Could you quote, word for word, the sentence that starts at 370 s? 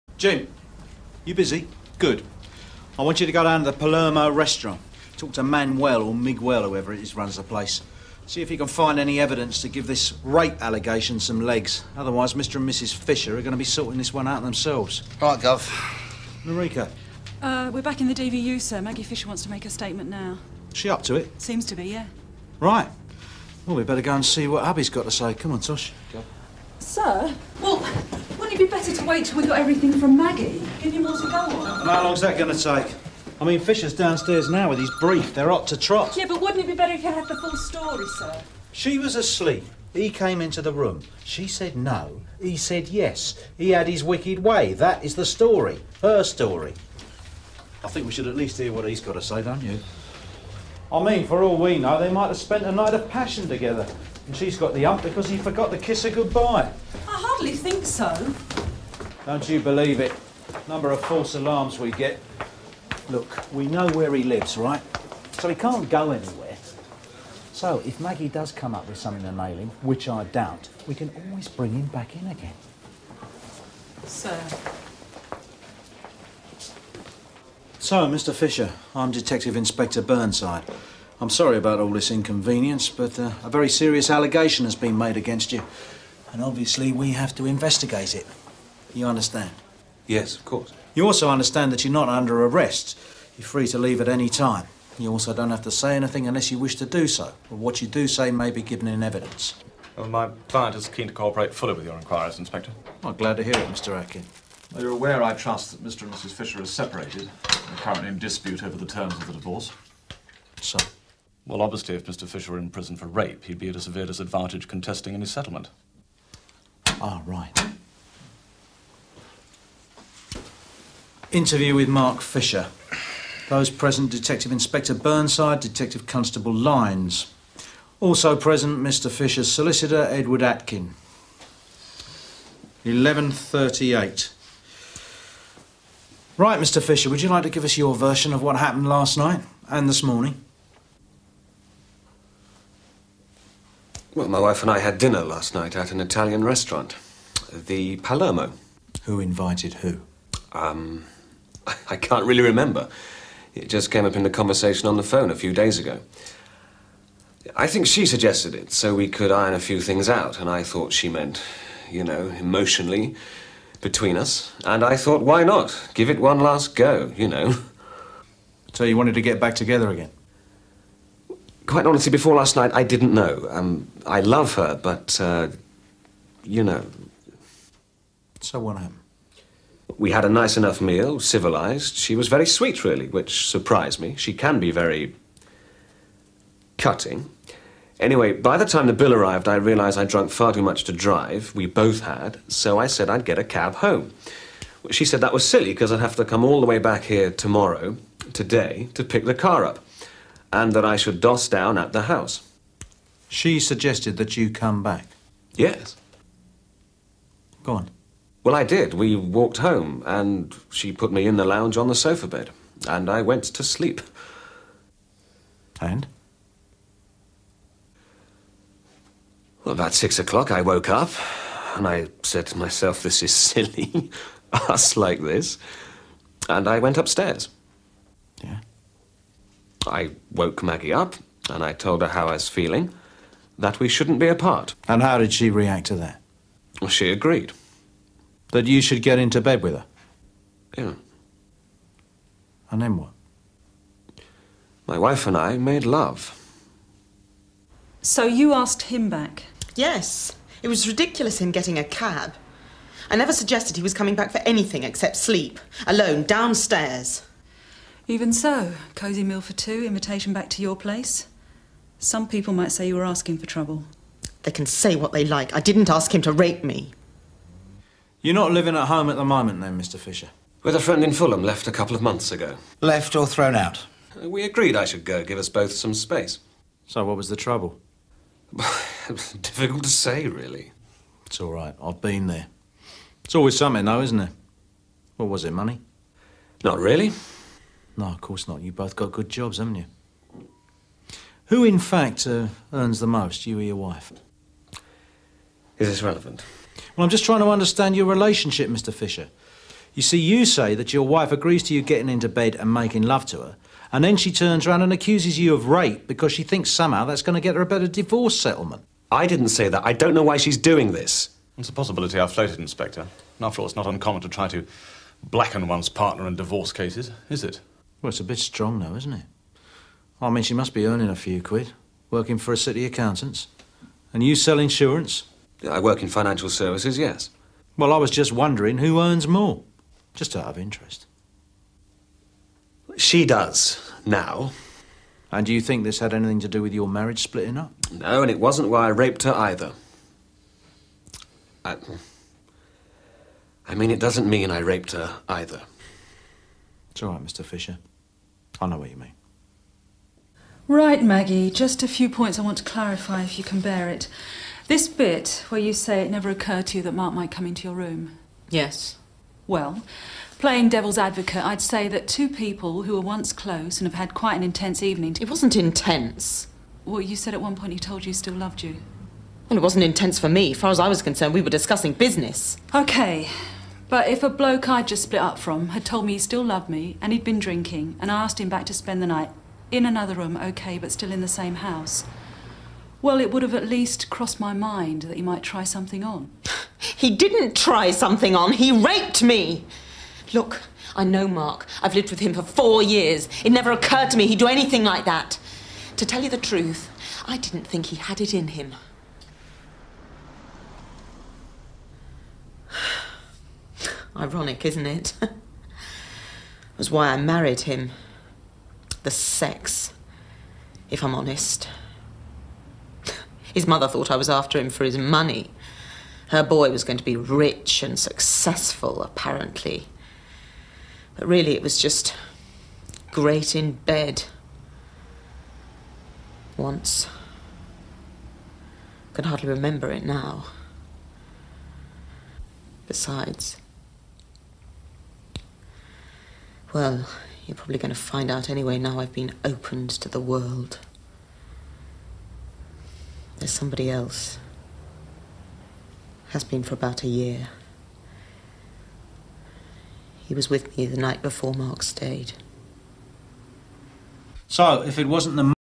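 As far as I was concerned, we were discussing business.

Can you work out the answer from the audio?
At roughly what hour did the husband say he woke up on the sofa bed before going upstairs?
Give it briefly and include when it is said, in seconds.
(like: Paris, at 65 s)
six o'clock, at 219 s.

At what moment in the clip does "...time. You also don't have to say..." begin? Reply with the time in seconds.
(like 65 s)
94 s.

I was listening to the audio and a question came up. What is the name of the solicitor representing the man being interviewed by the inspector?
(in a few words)
Edward Atkin.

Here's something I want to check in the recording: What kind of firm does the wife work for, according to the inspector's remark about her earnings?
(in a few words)
City accountant's.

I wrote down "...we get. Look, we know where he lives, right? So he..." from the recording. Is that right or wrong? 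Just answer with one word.
right.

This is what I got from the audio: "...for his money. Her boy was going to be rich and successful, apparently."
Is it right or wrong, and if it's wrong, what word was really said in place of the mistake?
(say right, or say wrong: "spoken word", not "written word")
right.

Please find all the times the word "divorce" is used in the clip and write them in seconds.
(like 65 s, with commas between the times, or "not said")
109 s, 307 s, 316 s.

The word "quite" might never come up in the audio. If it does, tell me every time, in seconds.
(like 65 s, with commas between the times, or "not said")
171 s, 364 s.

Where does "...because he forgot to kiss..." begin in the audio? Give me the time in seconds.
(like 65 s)
55 s.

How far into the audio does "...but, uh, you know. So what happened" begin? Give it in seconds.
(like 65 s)
174 s.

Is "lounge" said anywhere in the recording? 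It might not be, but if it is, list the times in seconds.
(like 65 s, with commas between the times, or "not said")
211 s.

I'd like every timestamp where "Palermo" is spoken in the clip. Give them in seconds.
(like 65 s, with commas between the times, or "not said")
3 s, 147 s.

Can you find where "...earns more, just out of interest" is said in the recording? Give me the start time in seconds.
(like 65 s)
328 s.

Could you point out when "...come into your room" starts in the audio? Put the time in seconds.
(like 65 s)
357 s.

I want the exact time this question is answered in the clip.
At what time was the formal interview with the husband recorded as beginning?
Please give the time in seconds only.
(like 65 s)
132 s.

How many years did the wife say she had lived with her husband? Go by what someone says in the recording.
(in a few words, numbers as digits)
4.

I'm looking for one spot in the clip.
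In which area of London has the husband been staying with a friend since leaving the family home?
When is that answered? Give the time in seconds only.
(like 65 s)
271 s.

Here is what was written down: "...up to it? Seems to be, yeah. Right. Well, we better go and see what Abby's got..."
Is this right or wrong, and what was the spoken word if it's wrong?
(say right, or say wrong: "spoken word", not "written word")
right.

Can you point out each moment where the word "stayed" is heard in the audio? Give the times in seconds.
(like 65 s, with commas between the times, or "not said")
451 s.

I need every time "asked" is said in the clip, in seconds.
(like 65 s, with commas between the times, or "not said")
248 s, 378 s.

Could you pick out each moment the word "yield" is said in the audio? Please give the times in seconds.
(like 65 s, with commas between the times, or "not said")
not said.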